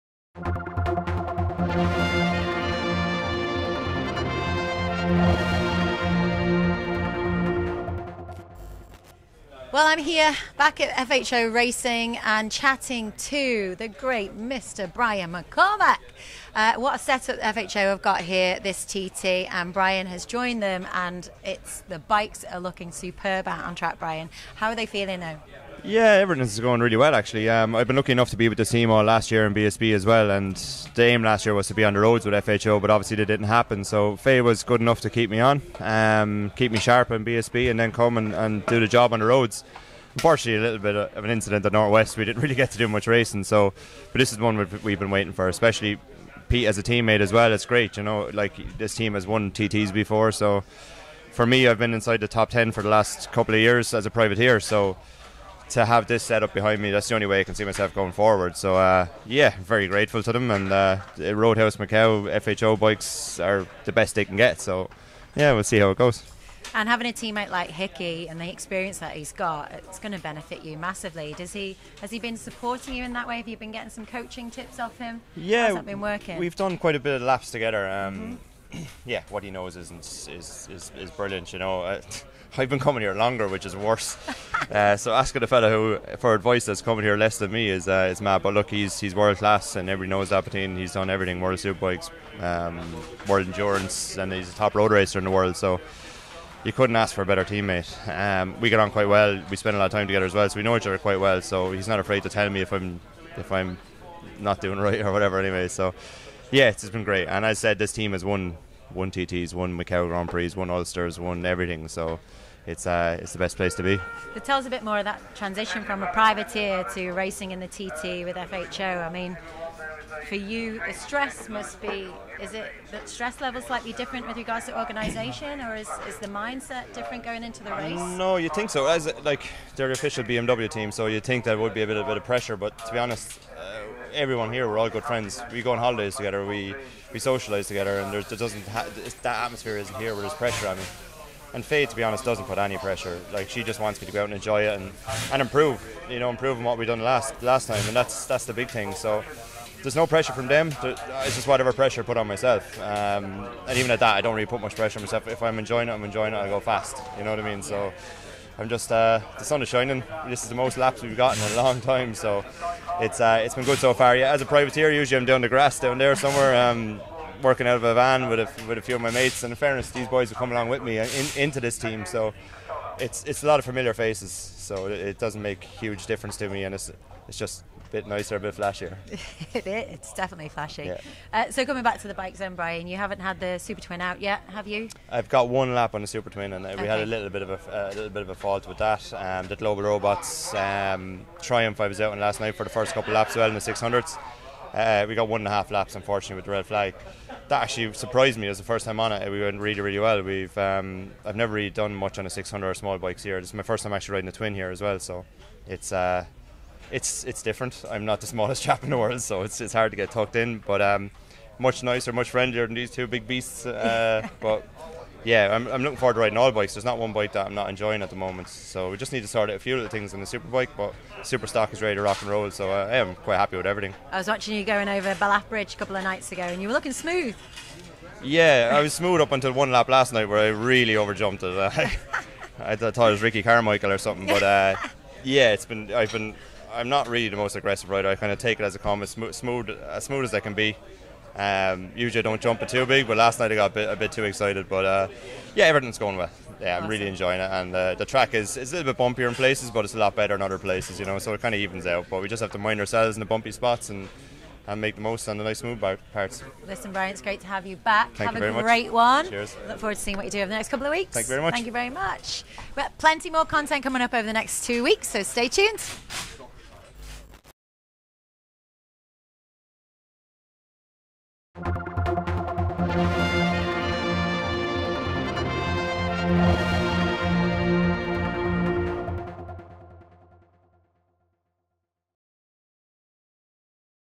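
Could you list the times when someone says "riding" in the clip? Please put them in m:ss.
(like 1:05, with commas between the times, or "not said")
3:24, 3:36.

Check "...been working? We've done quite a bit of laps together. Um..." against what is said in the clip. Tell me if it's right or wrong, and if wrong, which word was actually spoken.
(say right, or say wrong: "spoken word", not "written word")
right.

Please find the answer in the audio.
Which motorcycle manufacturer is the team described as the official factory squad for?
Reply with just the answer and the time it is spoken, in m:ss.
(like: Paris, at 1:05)
BMW, at 2:10.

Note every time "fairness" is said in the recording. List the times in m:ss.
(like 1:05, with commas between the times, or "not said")
2:49.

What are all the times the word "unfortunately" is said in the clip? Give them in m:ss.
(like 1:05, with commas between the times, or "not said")
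0:40, 3:15.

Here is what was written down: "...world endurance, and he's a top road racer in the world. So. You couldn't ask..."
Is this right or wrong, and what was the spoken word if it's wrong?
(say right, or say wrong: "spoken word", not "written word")
right.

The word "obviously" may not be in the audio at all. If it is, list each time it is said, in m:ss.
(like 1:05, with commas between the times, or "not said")
0:32.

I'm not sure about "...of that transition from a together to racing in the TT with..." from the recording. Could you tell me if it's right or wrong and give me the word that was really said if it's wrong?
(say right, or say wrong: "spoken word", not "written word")
wrong: "privateer", not "together".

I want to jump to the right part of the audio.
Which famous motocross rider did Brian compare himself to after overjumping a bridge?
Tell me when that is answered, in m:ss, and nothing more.
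3:53.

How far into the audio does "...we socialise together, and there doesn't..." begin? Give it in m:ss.
2:17.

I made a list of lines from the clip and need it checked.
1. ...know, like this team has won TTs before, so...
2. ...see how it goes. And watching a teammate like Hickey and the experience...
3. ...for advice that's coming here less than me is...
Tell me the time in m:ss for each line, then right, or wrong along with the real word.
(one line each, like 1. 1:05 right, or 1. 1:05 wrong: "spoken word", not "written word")
1. 0:48 right
2. 1:05 wrong: "having", not "watching"
3. 1:26 right.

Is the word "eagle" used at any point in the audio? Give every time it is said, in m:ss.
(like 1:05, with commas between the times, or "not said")
not said.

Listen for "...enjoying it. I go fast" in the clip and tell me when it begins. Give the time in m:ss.
2:36.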